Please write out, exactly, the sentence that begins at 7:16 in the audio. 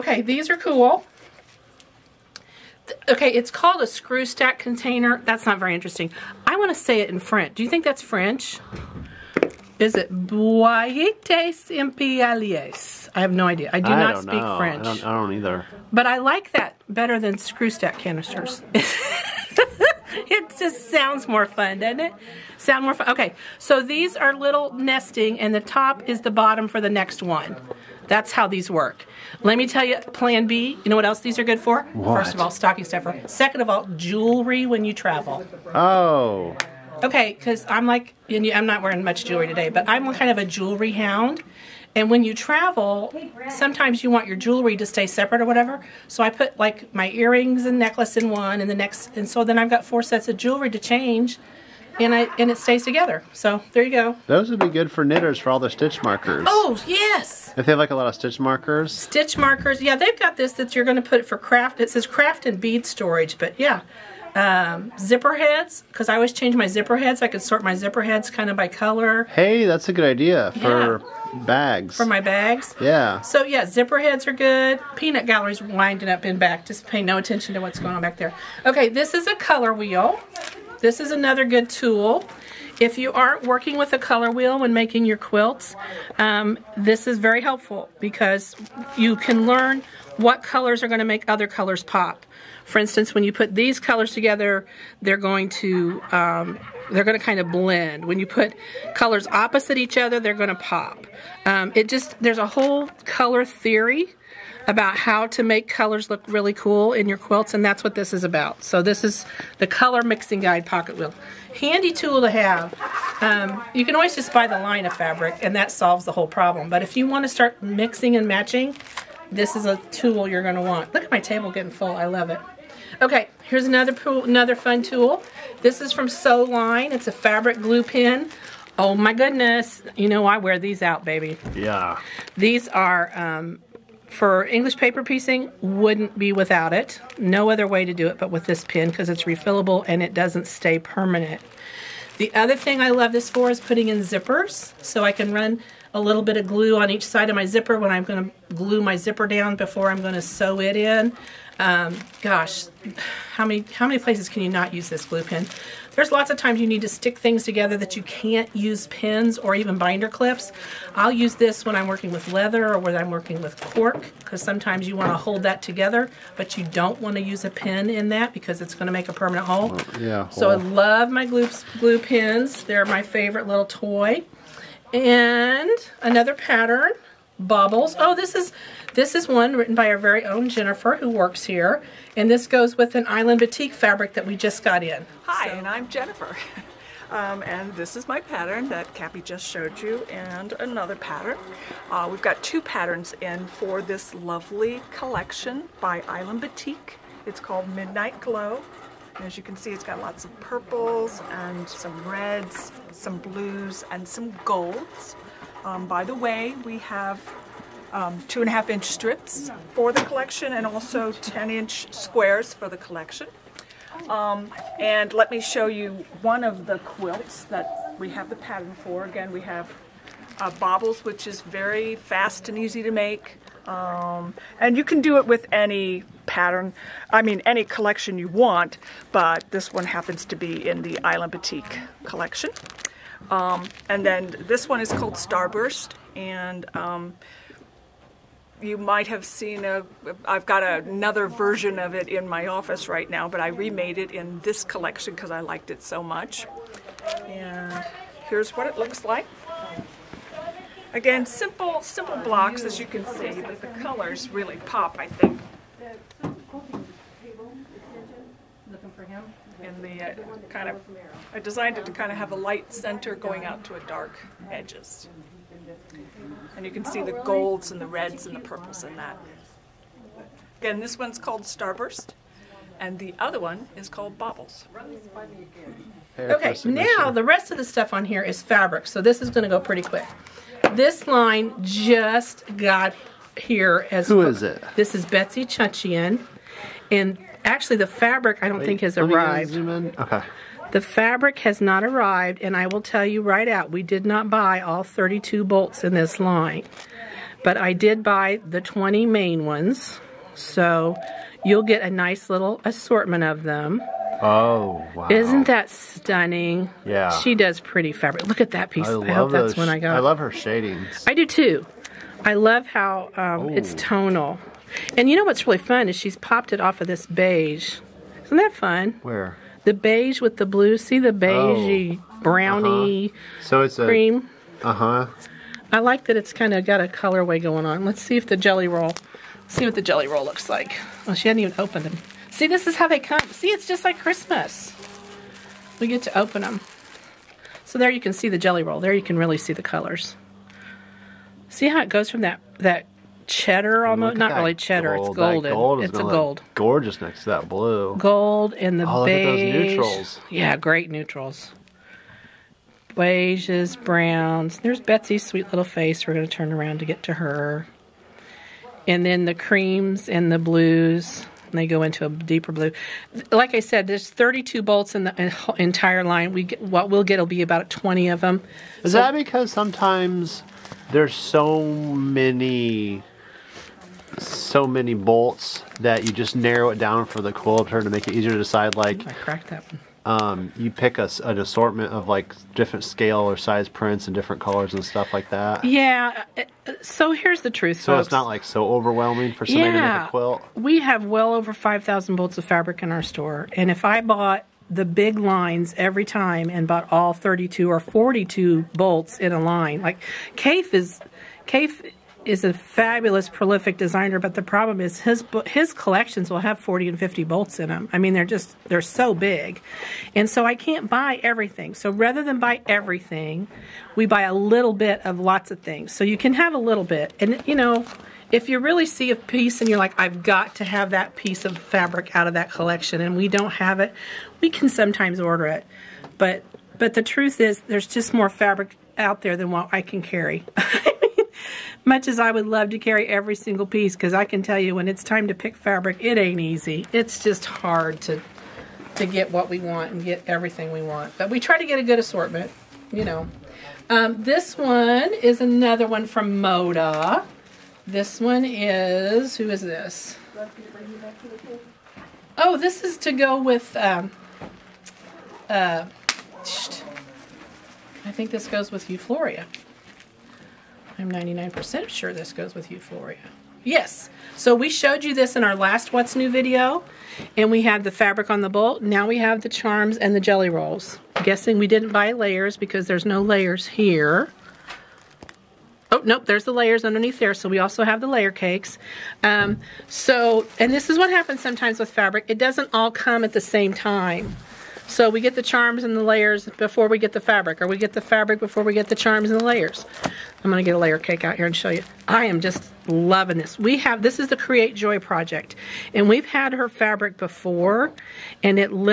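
It's just hard to to get what we want and get everything we want.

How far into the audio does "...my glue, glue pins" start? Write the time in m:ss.
2:51.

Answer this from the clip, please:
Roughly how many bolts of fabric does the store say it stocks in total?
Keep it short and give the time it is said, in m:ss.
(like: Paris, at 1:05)
Over 5,000, at 6:31.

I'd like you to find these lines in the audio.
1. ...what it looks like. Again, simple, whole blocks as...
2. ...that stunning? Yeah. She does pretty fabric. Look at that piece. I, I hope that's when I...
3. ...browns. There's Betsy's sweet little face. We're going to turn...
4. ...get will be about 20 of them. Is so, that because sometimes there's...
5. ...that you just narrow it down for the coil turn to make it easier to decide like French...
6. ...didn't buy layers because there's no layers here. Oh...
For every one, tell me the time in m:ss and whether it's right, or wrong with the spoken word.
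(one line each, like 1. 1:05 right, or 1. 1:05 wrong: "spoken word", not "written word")
1. 4:08 wrong: "simple", not "whole"
2. 5:05 right
3. 5:53 right
4. 6:07 right
5. 6:15 wrong: "Ooh", not "French"
6. 7:51 right.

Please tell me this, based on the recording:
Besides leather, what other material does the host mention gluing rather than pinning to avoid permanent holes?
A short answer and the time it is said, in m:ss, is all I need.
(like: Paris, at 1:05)
Cork, at 2:43.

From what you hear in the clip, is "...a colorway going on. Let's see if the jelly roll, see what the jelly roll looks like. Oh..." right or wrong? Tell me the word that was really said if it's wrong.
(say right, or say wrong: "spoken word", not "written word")
right.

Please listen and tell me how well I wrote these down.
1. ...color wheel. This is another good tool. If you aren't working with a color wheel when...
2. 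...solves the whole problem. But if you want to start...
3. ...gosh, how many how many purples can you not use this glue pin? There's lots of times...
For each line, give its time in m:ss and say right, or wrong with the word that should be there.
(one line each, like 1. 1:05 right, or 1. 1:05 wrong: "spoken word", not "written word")
1. 1:19 right
2. 1:55 right
3. 2:32 wrong: "places", not "purples".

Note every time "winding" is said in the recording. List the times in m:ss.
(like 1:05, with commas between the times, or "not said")
1:15.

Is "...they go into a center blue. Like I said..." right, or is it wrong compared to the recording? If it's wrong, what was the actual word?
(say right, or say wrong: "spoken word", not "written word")
wrong: "deeper", not "center".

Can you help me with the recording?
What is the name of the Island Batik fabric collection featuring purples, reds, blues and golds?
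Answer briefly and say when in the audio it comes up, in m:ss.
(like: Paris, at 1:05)
Midnight Glow, at 3:17.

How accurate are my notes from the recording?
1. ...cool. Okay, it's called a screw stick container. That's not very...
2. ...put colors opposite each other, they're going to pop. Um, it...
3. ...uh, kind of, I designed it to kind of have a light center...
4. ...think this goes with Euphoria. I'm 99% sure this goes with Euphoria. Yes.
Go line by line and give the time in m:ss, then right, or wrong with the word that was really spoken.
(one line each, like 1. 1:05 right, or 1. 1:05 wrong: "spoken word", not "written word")
1. 0:00 wrong: "stack", not "stick"
2. 1:38 right
3. 4:20 right
4. 7:38 right.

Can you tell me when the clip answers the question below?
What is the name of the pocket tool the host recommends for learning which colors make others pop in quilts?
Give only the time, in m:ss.
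1:49.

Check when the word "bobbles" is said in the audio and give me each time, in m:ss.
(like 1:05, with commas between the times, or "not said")
3:40, 4:34.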